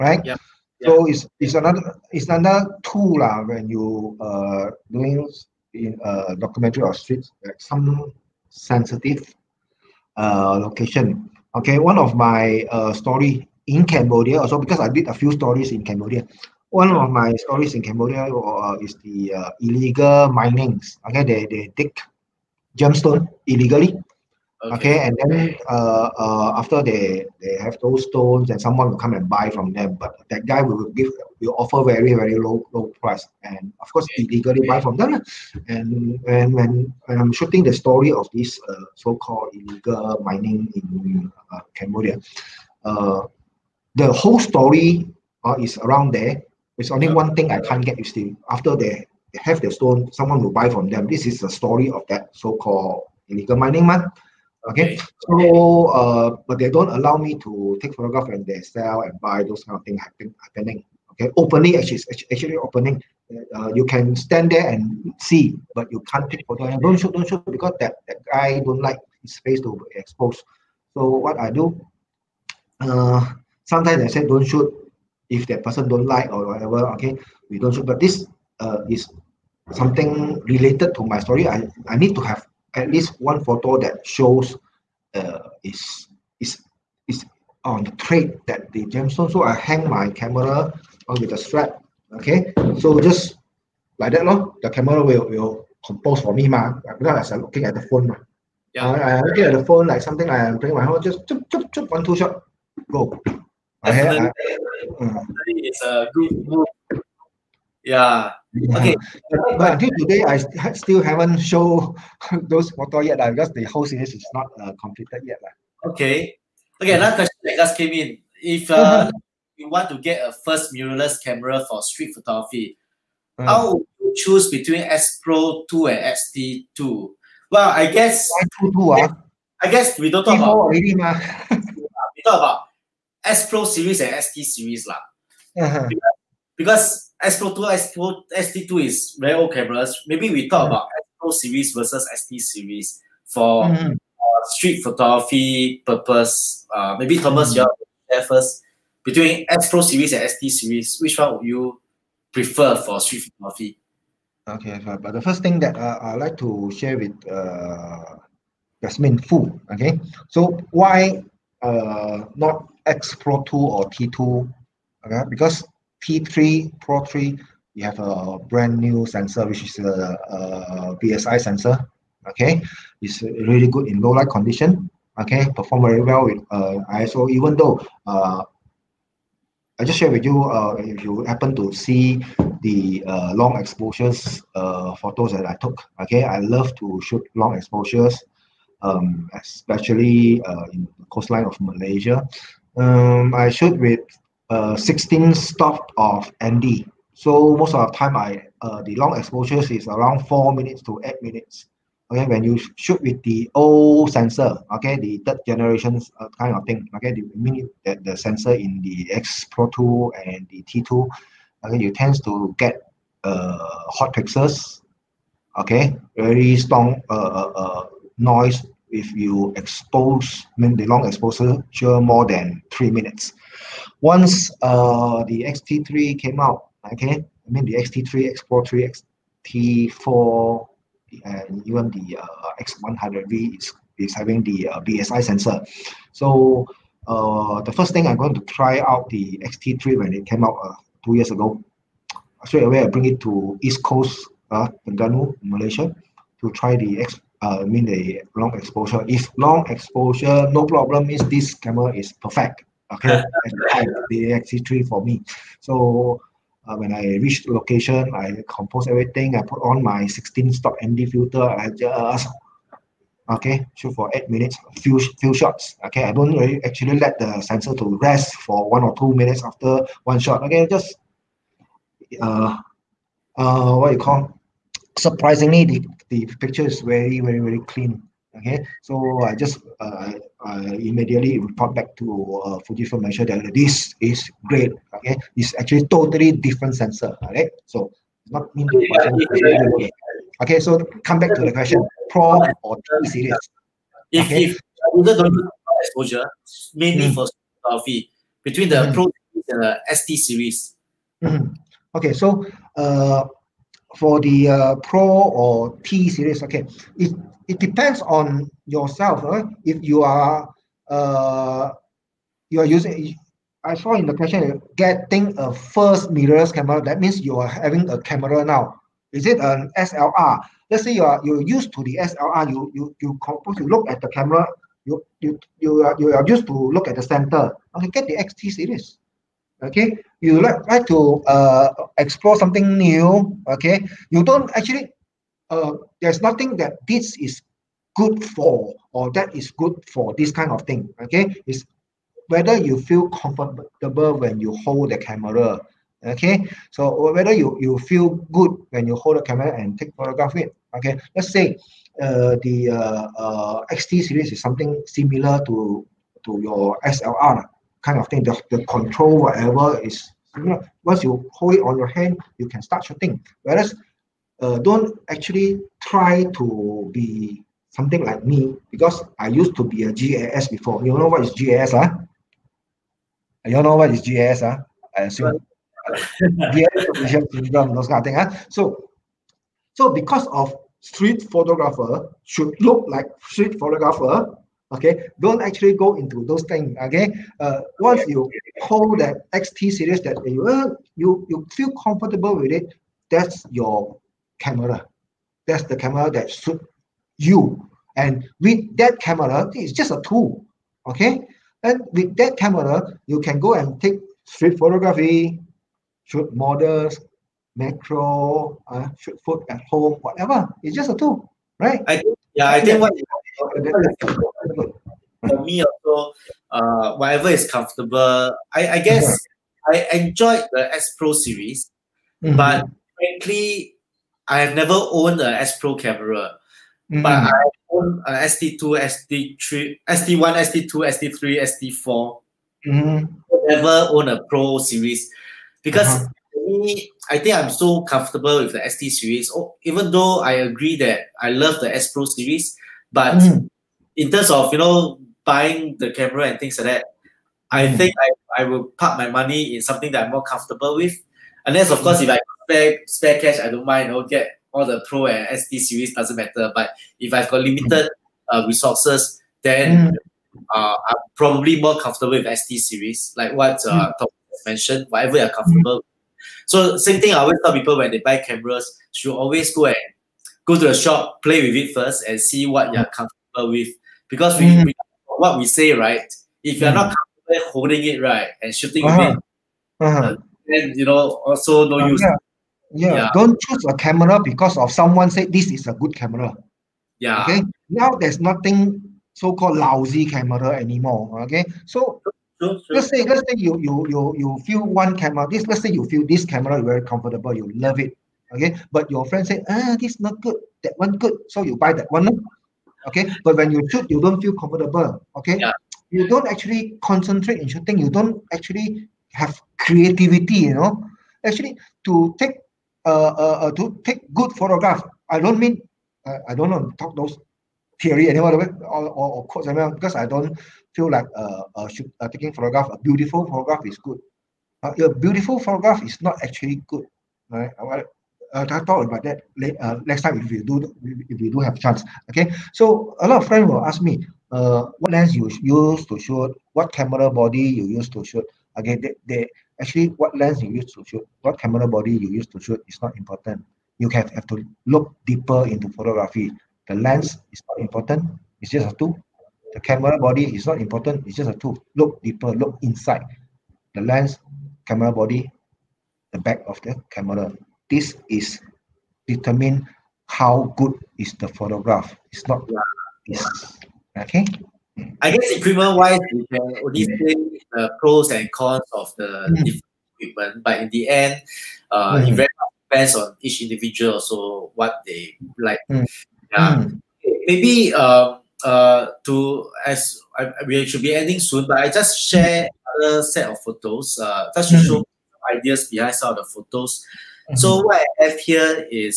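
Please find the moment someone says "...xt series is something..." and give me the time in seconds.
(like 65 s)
353 s.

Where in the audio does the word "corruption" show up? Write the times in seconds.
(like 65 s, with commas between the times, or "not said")
not said.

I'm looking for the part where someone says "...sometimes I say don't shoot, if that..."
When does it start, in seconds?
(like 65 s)
73 s.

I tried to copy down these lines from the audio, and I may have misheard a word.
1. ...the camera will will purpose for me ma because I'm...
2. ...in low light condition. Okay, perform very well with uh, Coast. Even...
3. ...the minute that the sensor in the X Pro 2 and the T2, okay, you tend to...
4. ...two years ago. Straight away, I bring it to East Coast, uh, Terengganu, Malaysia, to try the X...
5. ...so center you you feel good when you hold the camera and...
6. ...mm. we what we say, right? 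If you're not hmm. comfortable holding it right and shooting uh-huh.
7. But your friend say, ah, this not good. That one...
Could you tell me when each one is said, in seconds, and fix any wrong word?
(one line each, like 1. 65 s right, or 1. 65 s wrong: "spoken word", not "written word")
1. 94 s wrong: "compose", not "purpose"
2. 173 s wrong: "ISO", not "Coast"
3. 207 s right
4. 241 s right
5. 346 s wrong: "whether", not "center"
6. 474 s right
7. 498 s right.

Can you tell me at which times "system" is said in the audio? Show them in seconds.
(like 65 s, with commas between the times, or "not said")
not said.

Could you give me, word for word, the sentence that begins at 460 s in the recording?
uh, I'm probably more comfortable with XT series, like what uh, mm.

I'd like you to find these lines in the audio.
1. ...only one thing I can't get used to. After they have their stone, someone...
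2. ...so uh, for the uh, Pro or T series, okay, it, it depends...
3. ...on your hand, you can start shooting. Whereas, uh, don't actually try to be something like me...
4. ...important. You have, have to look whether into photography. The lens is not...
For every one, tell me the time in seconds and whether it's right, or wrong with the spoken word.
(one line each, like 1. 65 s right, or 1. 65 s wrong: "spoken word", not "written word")
1. 46 s right
2. 302 s right
3. 361 s right
4. 542 s wrong: "deeper", not "whether".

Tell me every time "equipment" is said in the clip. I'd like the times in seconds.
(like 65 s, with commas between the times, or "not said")
565 s, 569 s.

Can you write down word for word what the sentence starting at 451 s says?
Unless, of course, if I spare, spare cash, I don't mind.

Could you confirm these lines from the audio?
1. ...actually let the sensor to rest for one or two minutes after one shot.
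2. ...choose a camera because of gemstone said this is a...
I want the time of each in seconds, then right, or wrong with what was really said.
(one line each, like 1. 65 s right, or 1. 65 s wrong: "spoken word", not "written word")
1. 266 s right
2. 483 s wrong: "someone", not "gemstone".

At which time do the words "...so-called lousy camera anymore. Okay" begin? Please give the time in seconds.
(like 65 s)
489 s.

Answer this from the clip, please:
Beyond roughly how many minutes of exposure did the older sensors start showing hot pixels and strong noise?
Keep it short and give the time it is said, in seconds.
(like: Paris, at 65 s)
3 minutes, at 222 s.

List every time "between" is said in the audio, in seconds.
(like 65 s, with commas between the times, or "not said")
124 s, 149 s, 298 s.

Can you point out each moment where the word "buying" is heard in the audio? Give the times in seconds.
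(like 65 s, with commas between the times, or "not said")
445 s.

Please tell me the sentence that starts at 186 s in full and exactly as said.
Okay, I love to shoot long exposures, um, especially uh, in the coastline of Malaysia.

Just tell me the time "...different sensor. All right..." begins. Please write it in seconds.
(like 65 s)
286 s.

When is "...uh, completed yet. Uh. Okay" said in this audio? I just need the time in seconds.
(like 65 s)
114 s.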